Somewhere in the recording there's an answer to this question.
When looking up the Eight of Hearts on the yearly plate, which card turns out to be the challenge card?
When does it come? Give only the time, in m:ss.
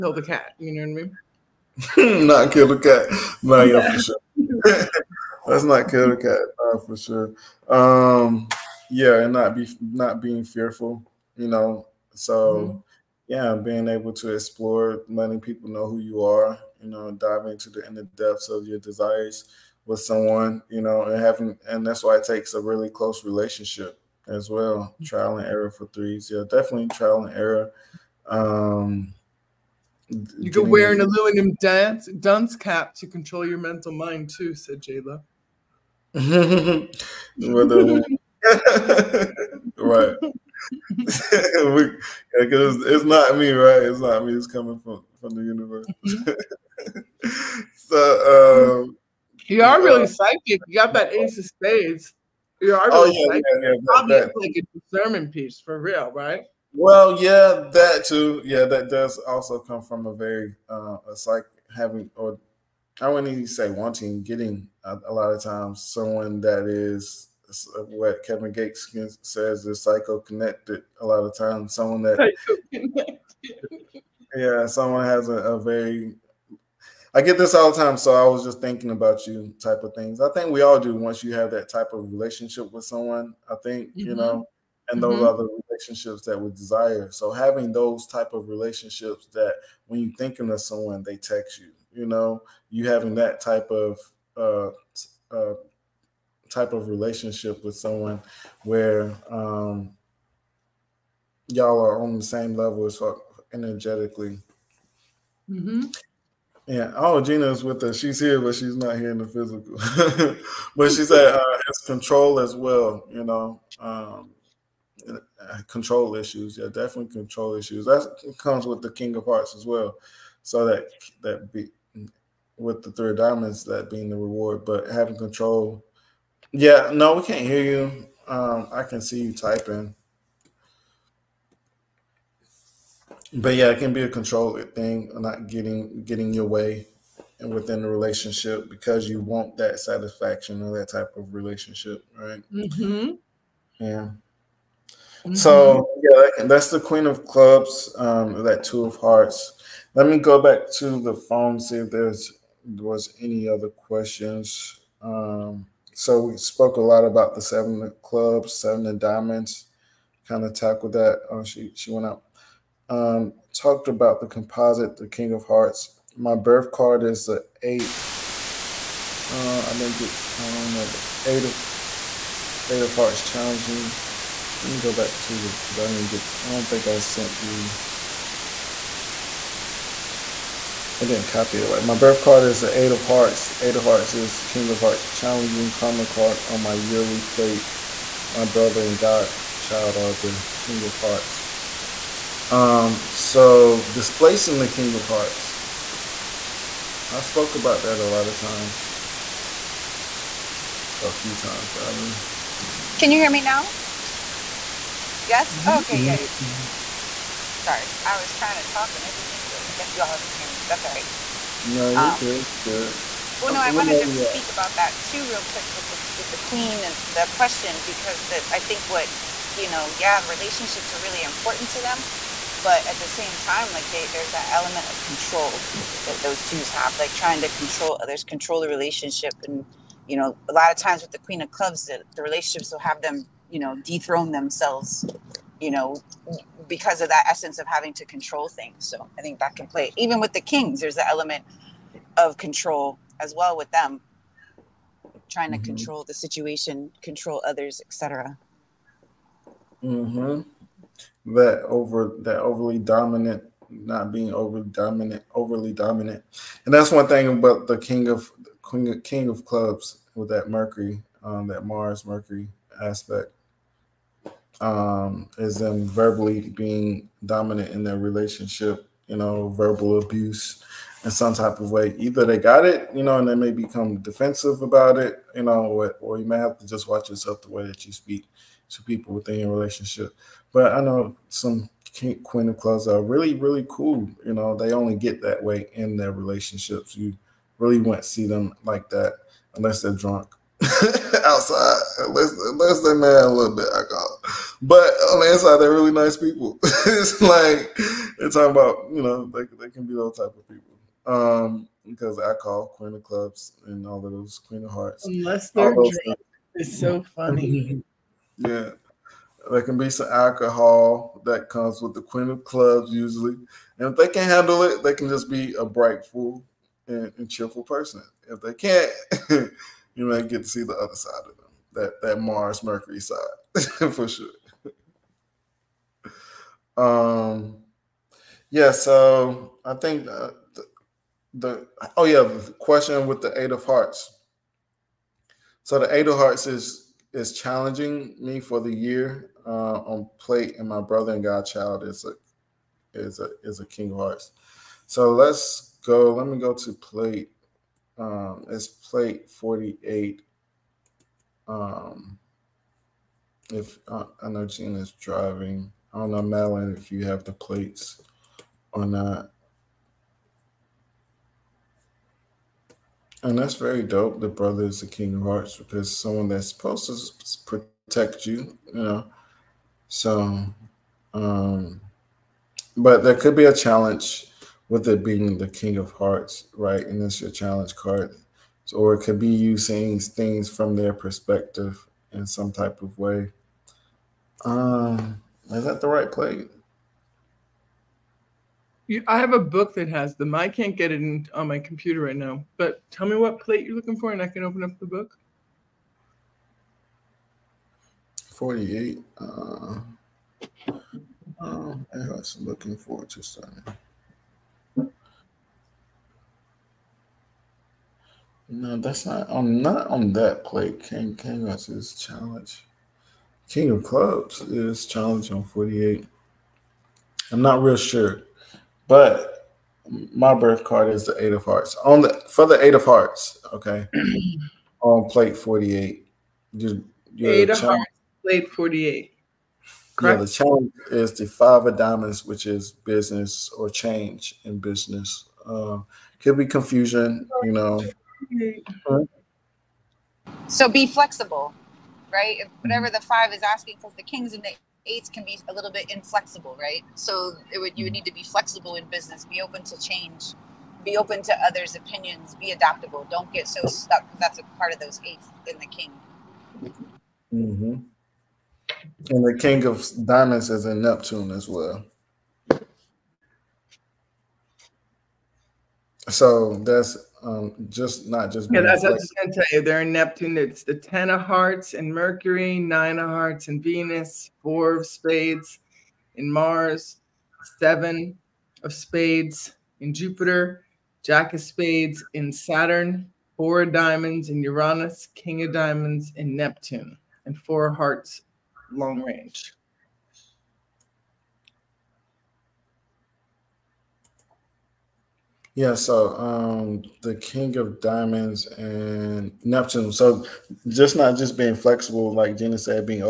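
7:11.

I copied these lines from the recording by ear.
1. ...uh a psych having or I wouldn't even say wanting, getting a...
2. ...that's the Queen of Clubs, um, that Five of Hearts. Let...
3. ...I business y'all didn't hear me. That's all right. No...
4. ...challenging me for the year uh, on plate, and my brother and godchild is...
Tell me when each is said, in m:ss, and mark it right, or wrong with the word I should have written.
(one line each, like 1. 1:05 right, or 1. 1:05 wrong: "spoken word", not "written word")
1. 1:00 right
2. 2:26 wrong: "Two", not "Five"
3. 3:29 wrong: "guess", not "business"
4. 5:37 right.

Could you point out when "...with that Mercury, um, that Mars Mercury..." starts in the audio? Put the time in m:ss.
4:20.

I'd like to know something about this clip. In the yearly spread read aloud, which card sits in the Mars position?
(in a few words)
Four of Spades.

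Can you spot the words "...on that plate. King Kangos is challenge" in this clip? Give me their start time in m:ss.
6:49.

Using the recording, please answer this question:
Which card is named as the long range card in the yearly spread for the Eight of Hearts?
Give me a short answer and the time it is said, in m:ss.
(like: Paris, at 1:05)
Four of Hearts, at 8:07.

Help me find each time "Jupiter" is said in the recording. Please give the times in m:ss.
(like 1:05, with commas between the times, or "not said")
7:59.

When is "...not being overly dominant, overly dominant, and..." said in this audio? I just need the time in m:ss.
4:13.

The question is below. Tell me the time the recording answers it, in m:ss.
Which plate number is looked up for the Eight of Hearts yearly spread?
5:49.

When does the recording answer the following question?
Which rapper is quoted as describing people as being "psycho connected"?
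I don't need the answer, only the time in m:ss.
1:08.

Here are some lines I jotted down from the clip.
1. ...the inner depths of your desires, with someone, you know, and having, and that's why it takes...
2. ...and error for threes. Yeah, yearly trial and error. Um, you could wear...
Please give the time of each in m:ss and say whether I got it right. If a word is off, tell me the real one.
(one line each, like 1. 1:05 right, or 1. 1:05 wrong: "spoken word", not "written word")
1. 0:17 right
2. 0:25 wrong: "definitely", not "yearly".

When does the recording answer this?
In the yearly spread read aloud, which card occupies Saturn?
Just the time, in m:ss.
8:01.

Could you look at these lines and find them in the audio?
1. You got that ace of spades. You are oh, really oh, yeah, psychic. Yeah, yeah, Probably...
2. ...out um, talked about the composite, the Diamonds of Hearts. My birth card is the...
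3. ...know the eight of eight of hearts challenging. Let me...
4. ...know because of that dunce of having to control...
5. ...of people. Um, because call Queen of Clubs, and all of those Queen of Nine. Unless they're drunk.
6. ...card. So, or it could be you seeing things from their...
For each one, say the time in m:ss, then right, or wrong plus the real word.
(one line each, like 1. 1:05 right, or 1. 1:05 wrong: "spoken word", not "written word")
1. 0:50 right
2. 2:42 wrong: "King", not "Diamonds"
3. 2:50 right
4. 3:55 wrong: "essence", not "dunce"
5. 5:00 wrong: "Hearts", not "Nine"
6. 6:17 right.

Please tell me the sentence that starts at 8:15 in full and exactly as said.
Yeah, so um, the King of Diamonds and Neptune.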